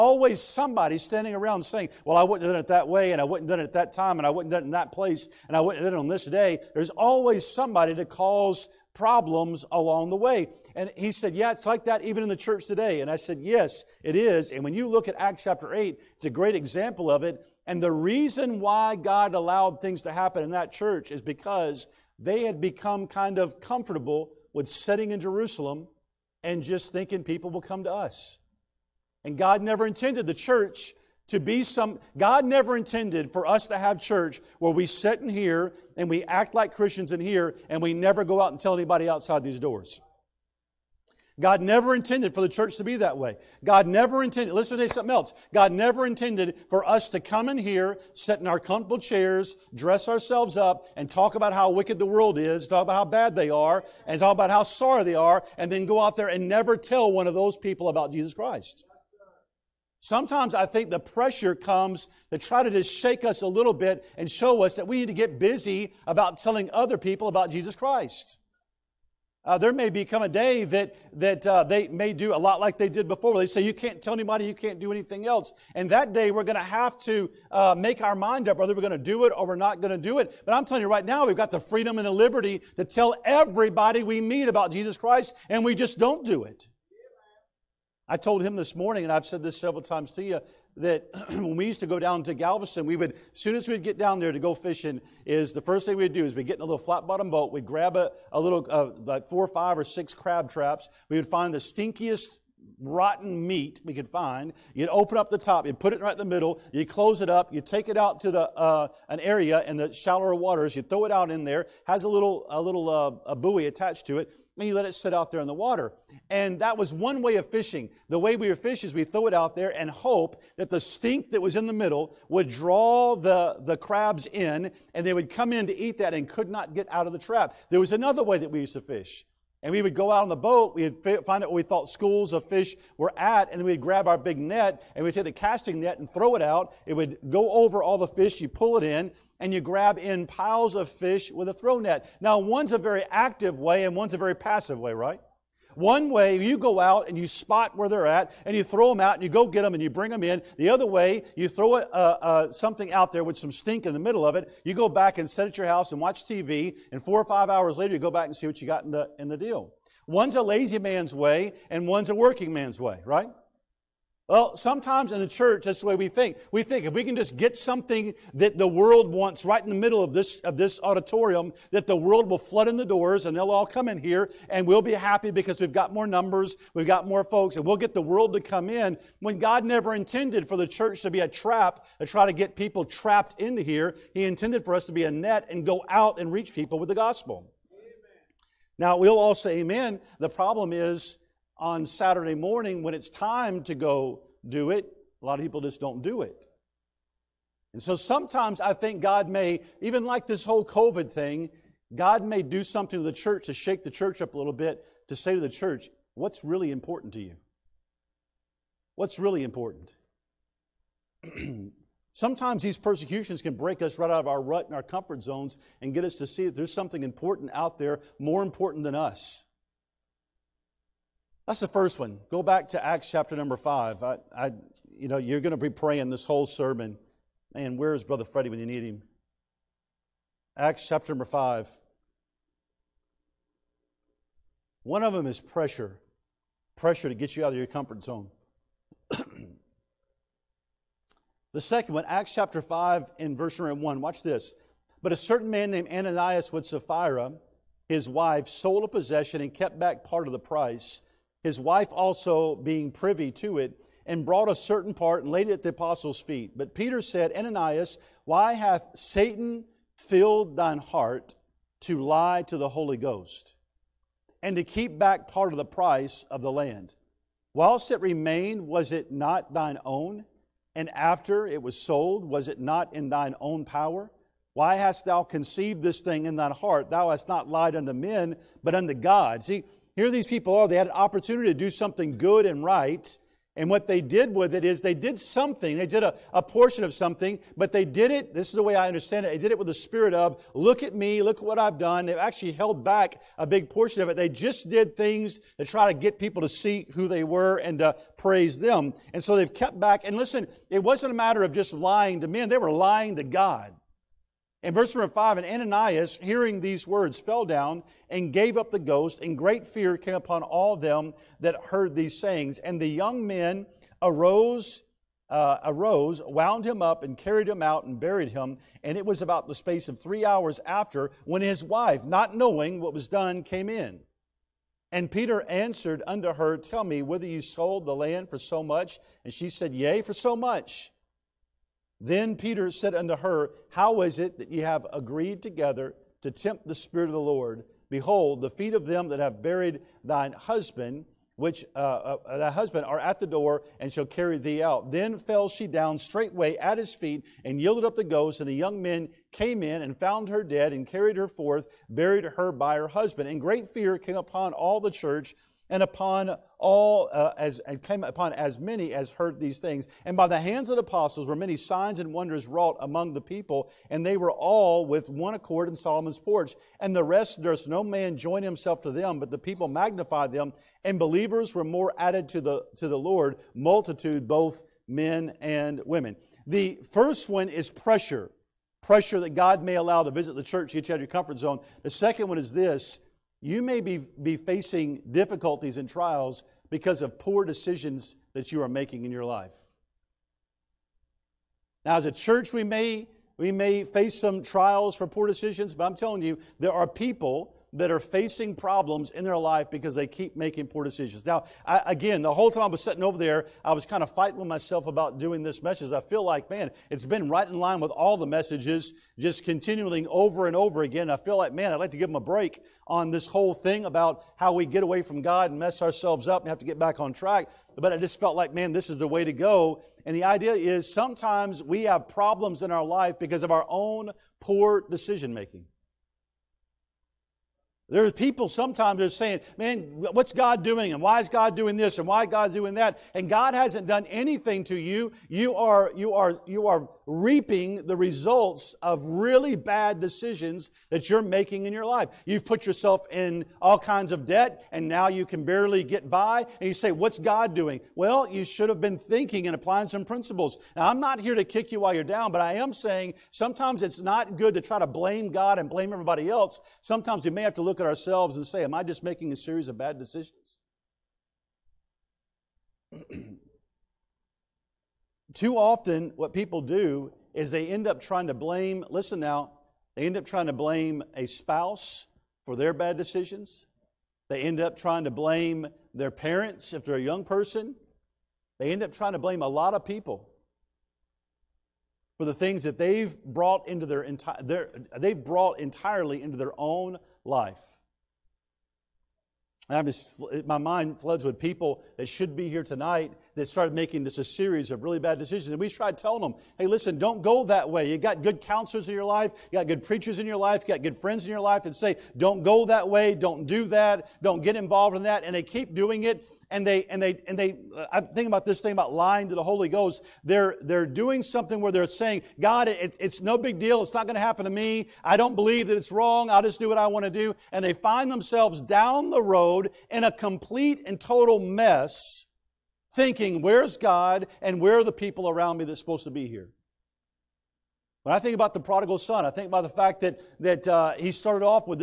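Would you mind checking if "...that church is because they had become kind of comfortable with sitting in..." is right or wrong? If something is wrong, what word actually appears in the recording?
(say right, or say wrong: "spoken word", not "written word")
right.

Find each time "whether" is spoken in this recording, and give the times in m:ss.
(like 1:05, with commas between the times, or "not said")
1:18, 5:27.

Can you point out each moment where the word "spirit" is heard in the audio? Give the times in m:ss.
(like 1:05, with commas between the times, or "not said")
4:49, 5:36.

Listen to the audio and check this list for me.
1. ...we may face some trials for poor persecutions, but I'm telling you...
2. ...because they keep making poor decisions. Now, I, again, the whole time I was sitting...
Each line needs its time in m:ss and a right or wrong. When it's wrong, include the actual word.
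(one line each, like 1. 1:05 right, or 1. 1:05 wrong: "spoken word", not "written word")
1. 6:33 wrong: "decisions", not "persecutions"
2. 6:39 right.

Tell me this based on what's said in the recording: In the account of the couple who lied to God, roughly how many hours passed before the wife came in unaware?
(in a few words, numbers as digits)
3.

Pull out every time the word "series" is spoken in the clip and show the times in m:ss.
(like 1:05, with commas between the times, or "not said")
7:39, 8:14.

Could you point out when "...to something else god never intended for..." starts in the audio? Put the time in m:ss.
0:44.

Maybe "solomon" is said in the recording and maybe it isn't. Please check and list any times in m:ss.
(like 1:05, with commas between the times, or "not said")
6:05.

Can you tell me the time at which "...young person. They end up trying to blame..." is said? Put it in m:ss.
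7:56.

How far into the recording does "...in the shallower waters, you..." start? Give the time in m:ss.
1:49.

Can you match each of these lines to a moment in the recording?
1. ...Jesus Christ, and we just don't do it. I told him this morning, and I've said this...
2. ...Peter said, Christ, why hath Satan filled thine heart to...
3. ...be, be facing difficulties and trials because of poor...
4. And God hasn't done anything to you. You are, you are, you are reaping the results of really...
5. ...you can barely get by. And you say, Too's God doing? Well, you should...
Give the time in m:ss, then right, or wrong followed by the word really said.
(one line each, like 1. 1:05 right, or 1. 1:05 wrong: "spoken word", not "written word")
1. 1:24 right
2. 4:16 wrong: "Ananias", not "Christ"
3. 6:23 right
4. 7:13 right
5. 7:25 wrong: "What", not "Too".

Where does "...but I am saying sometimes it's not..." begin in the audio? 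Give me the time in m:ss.
7:32.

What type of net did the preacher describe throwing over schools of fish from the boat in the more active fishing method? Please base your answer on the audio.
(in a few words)
casting net.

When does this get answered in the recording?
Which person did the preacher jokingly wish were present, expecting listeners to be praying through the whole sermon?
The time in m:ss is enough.
3:48.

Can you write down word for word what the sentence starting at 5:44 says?
Then fell she down straightway at his feet, and yielded up the ghost.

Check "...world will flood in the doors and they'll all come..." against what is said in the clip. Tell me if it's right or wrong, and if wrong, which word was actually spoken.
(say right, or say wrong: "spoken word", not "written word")
right.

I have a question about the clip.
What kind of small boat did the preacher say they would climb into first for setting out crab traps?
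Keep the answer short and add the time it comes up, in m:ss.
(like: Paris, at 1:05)
flat bottom boat, at 1:36.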